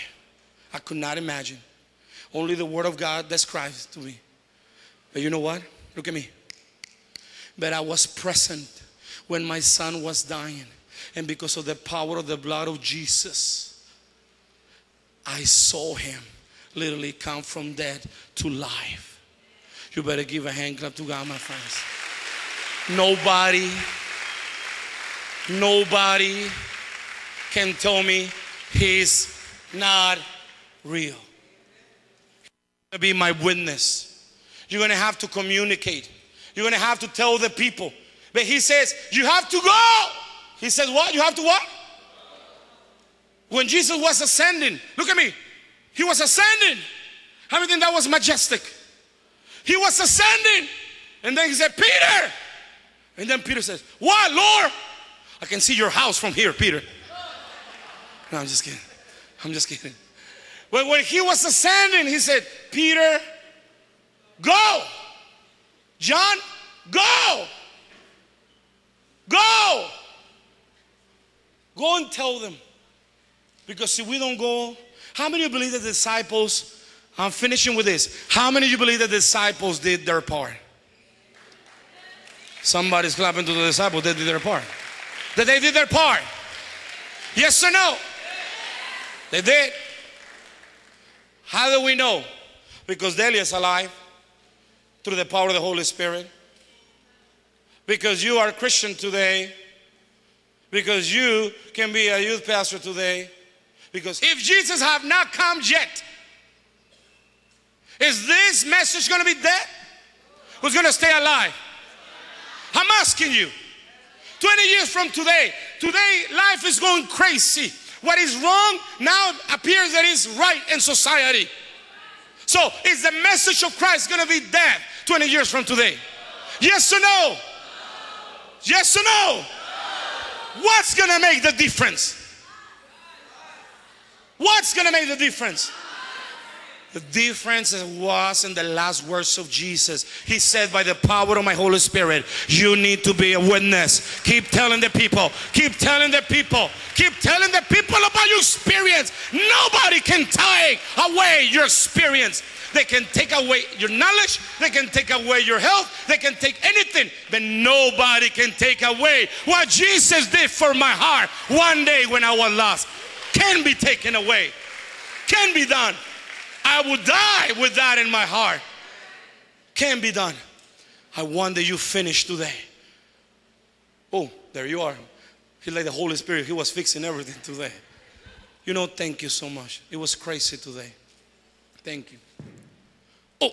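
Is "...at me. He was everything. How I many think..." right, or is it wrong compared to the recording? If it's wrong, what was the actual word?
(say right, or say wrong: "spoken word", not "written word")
wrong: "ascending", not "everything".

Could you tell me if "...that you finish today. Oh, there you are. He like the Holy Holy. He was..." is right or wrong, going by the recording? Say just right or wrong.
wrong.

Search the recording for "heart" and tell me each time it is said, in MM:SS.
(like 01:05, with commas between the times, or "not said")
02:40, 02:48.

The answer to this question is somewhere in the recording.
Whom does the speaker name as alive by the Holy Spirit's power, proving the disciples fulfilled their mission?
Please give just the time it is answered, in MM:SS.
01:33.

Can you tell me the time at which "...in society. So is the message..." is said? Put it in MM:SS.
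02:00.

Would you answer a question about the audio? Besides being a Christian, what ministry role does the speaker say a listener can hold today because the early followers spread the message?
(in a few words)
youth pastor.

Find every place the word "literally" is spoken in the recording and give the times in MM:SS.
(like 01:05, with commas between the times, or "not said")
00:16.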